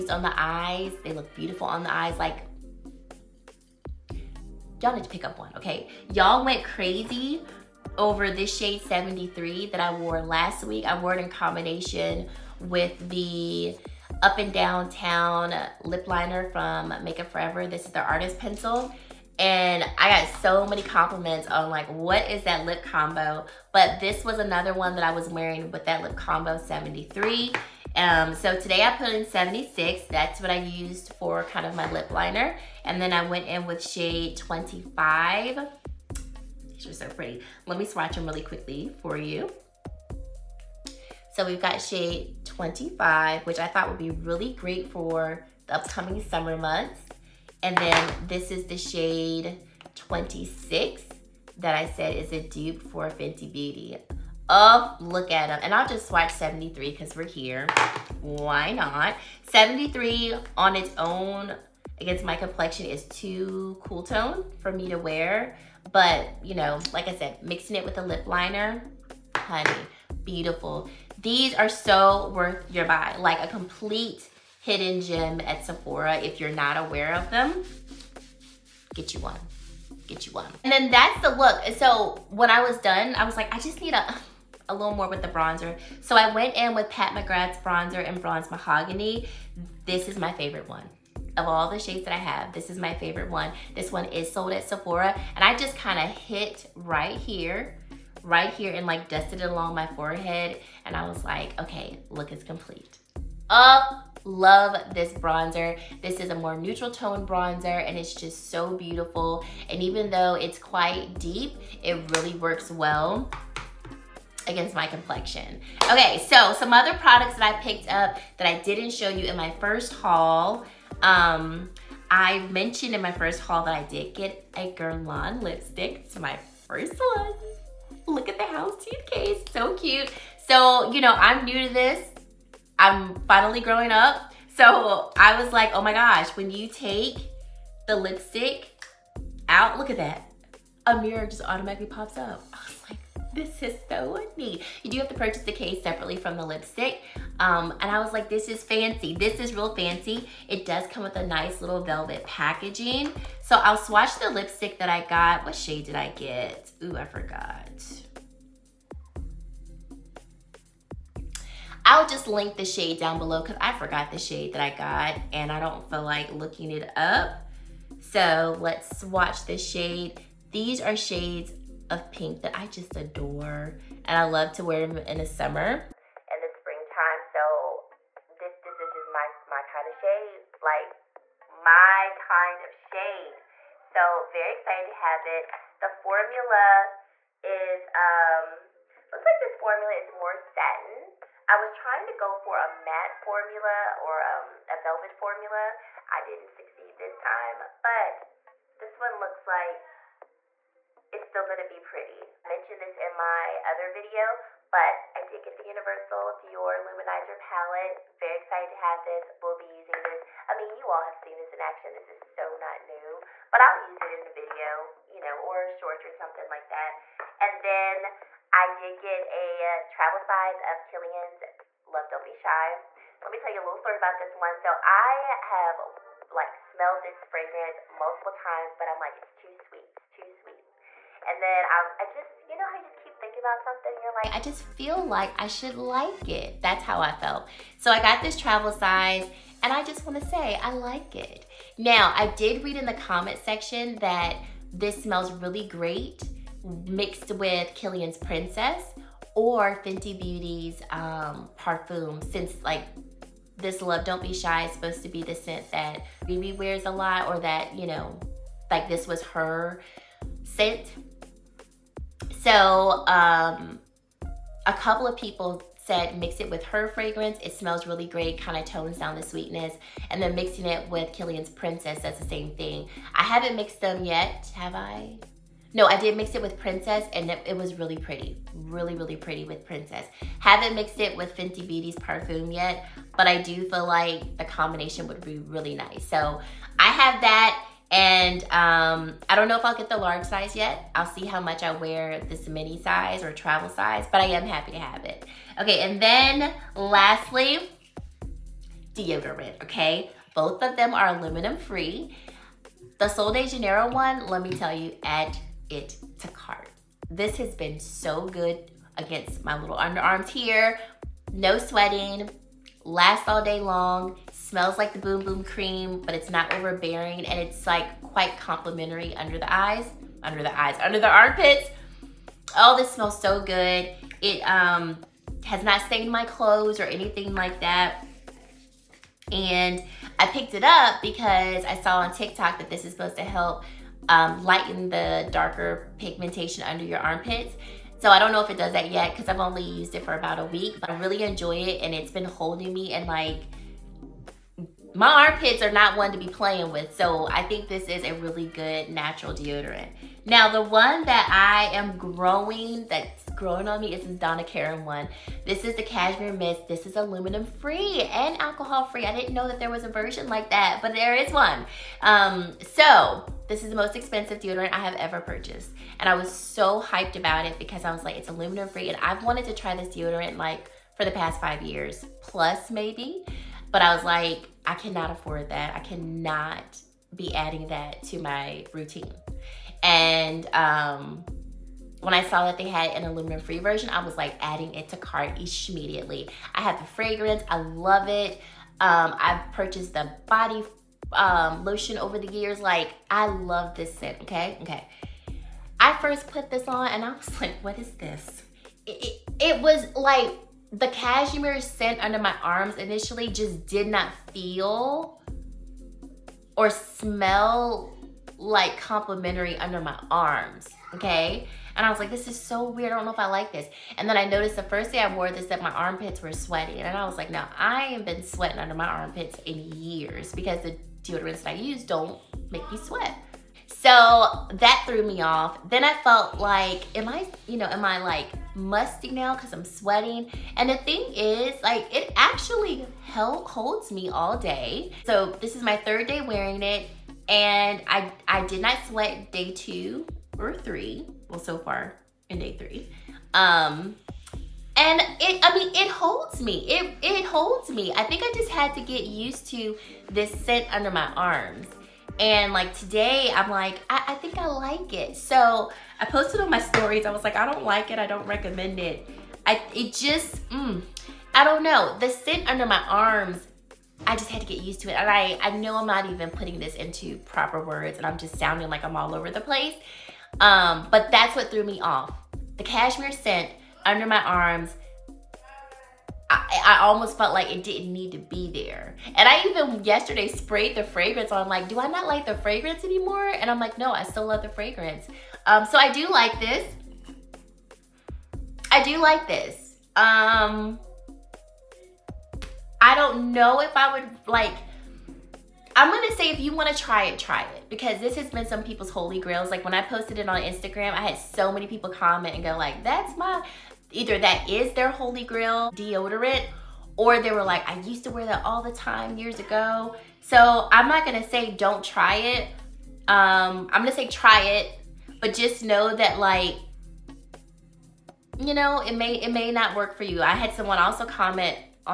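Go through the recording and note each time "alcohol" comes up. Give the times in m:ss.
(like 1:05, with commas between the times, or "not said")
5:58.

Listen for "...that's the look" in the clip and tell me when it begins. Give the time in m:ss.
1:20.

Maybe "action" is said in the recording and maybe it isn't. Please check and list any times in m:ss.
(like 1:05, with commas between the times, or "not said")
3:31.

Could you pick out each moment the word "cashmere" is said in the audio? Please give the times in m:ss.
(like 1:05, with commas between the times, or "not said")
5:55, 6:40, 7:52.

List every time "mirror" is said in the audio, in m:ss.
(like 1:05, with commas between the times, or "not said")
2:21.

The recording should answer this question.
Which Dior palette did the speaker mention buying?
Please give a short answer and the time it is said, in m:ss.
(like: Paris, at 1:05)
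Universal Dior Luminizer, at 3:25.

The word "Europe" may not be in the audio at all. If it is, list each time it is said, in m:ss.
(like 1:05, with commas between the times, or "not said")
not said.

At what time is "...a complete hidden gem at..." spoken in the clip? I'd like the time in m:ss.
1:13.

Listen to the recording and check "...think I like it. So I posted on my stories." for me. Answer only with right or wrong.
right.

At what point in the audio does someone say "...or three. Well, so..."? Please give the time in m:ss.
7:20.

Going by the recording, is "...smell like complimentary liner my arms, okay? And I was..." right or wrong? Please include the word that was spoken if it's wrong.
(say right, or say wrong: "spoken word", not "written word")
wrong: "under", not "liner".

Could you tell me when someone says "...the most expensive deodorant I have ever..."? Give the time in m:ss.
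6:03.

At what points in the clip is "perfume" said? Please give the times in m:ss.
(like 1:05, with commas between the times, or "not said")
4:41.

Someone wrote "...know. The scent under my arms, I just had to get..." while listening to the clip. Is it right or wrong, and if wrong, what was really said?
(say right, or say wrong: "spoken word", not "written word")
right.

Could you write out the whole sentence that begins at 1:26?
So I went in with Pat McGrath's bronzer in Bronze Mahogany.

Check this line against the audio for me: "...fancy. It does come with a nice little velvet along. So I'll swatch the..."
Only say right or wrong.
wrong.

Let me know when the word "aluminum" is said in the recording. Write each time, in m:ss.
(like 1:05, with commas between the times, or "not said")
5:01, 5:56, 6:08, 6:23.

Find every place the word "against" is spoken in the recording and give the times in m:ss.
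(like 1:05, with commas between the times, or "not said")
1:02, 1:54, 5:08.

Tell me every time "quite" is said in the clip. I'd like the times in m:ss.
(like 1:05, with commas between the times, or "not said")
1:50, 5:18.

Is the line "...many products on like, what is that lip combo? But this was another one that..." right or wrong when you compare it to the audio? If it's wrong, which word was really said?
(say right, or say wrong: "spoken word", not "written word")
wrong: "compliments", not "products".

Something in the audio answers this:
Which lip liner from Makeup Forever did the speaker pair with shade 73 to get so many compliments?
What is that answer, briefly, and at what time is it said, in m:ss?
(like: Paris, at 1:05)
Up and Downtown, at 0:14.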